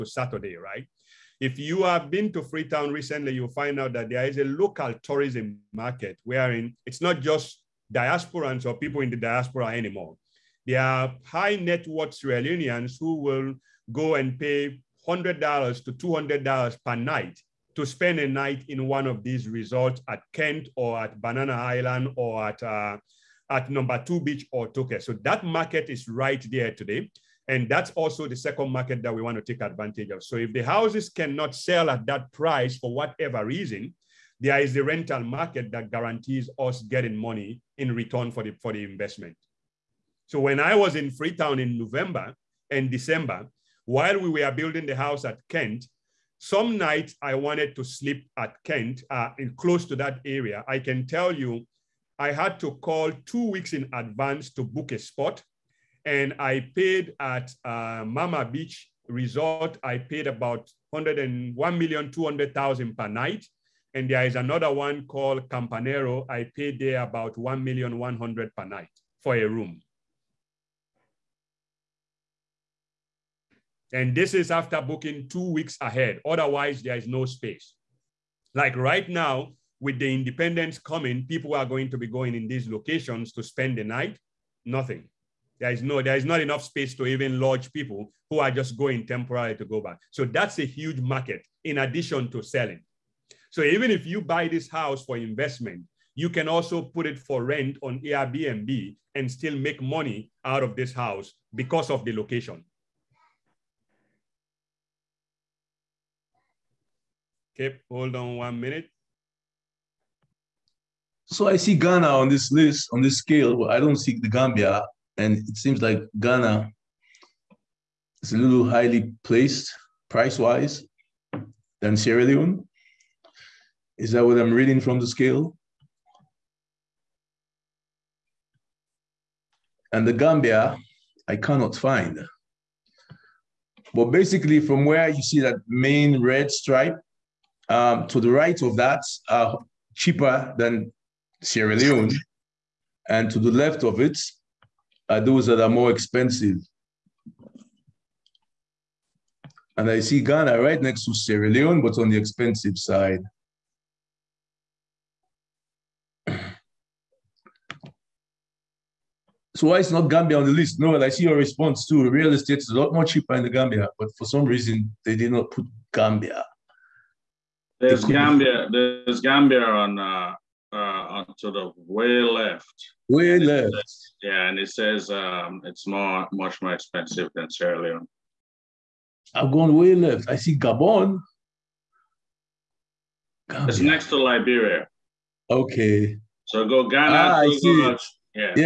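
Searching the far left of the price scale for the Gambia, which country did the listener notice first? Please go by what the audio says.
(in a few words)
Gabon.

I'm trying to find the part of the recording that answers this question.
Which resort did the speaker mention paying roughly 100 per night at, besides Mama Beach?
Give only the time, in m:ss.
1:05.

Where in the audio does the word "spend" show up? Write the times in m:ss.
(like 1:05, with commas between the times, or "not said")
0:17, 1:23.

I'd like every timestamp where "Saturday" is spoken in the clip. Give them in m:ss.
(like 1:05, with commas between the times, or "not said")
0:00.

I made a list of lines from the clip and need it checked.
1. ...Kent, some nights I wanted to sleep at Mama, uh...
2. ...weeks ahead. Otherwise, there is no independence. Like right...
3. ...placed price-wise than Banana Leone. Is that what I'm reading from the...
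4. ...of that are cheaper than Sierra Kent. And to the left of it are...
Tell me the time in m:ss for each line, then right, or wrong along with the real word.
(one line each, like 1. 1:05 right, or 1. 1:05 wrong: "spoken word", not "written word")
1. 0:45 wrong: "Kent", not "Mama"
2. 1:15 wrong: "space", not "independence"
3. 1:59 wrong: "Sierra", not "Banana"
4. 2:18 wrong: "Leone", not "Kent".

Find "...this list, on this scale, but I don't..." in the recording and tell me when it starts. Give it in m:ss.
1:52.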